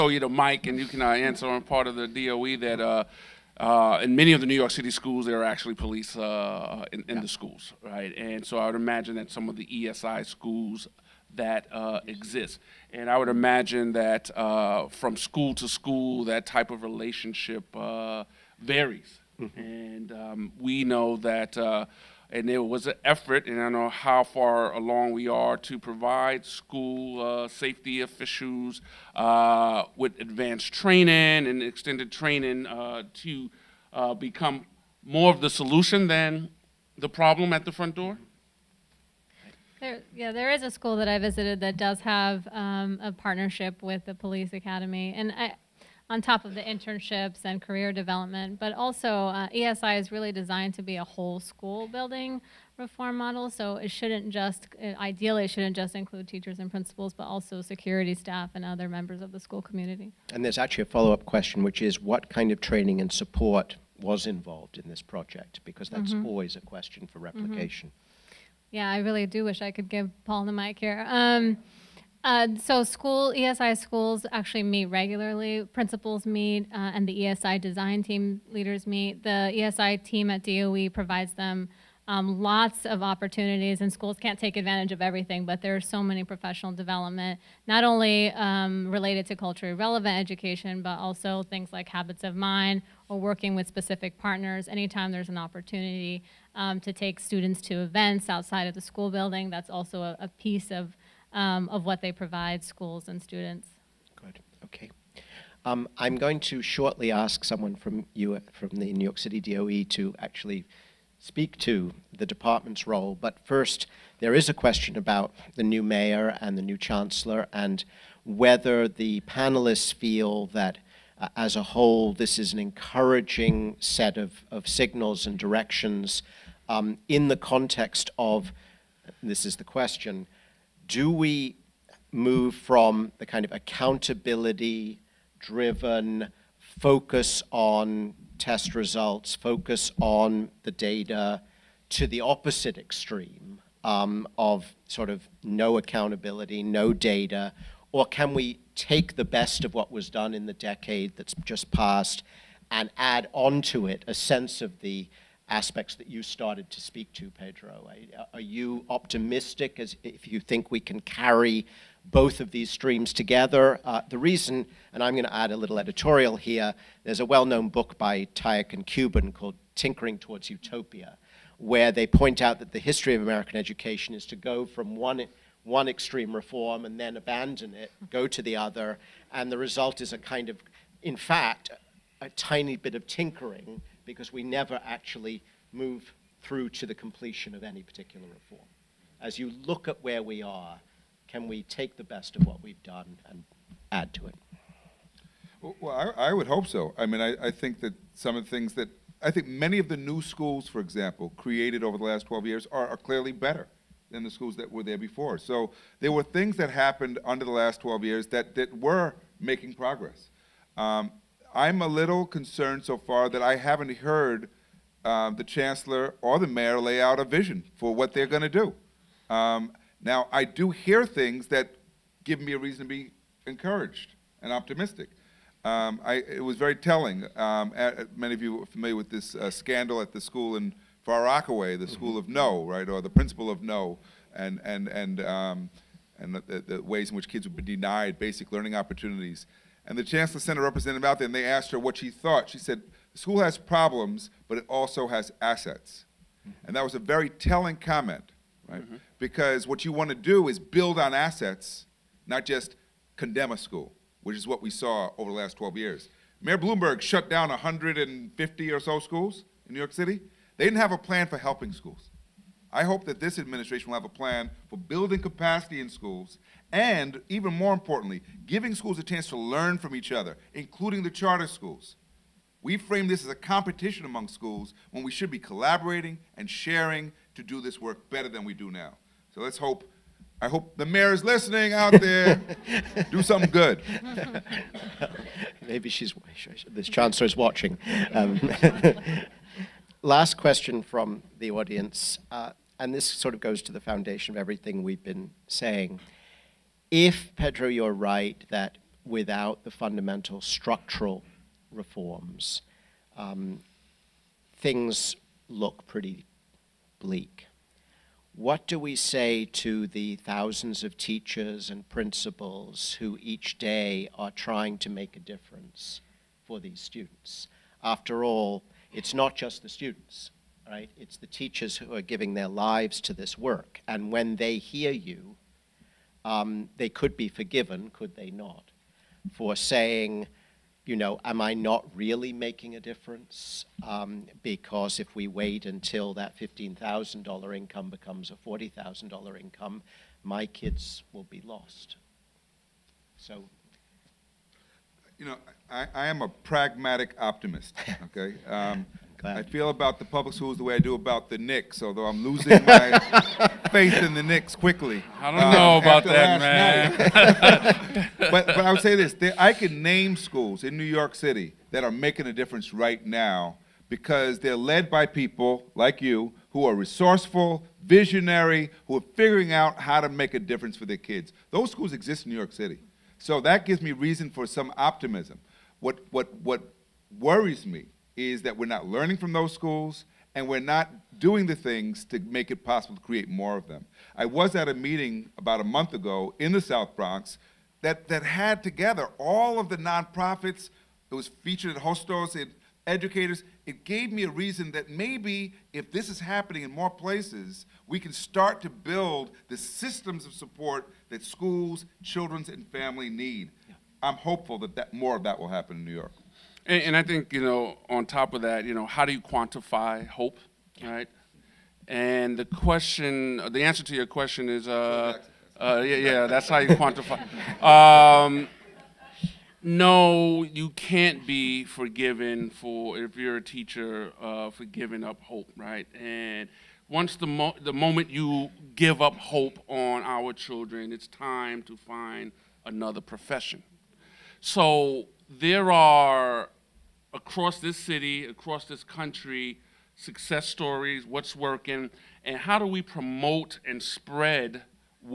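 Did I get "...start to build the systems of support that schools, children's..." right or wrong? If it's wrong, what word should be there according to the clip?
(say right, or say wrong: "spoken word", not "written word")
right.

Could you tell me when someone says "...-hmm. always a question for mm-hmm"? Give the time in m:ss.
1:06.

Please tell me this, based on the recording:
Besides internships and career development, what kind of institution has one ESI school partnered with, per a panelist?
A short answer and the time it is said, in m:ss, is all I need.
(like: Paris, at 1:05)
the police academy, at 0:44.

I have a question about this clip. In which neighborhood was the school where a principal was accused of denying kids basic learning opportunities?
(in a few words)
Far Rockaway.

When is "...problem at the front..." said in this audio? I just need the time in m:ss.
0:37.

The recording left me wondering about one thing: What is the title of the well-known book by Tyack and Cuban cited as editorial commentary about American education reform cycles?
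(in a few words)
Tinkering Towards Utopia.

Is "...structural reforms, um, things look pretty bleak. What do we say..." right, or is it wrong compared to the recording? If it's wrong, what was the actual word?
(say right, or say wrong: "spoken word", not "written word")
right.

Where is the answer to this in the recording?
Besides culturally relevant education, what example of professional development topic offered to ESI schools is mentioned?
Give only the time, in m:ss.
1:31.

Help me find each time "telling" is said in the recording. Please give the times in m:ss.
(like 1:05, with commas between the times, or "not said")
3:46, 4:07.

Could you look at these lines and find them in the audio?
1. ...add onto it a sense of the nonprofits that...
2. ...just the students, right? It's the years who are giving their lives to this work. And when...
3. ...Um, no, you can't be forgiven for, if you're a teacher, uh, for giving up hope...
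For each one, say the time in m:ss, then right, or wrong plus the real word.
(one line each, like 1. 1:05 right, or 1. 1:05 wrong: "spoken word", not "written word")
1. 2:32 wrong: "aspects", not "nonprofits"
2. 5:19 wrong: "teachers", not "years"
3. 6:57 right.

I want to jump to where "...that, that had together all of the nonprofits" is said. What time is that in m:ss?
6:27.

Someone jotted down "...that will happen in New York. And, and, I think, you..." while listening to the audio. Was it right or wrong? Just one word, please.
right.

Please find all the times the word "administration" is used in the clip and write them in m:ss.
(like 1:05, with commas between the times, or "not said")
4:23.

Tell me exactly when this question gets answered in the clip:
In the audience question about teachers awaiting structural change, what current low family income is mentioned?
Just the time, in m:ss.
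5:36.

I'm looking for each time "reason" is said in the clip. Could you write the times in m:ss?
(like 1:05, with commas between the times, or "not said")
2:44, 3:42, 6:13, 6:34.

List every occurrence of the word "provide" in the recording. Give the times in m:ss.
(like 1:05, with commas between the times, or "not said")
0:25, 1:20, 1:42.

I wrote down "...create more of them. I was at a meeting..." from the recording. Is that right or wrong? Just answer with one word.
right.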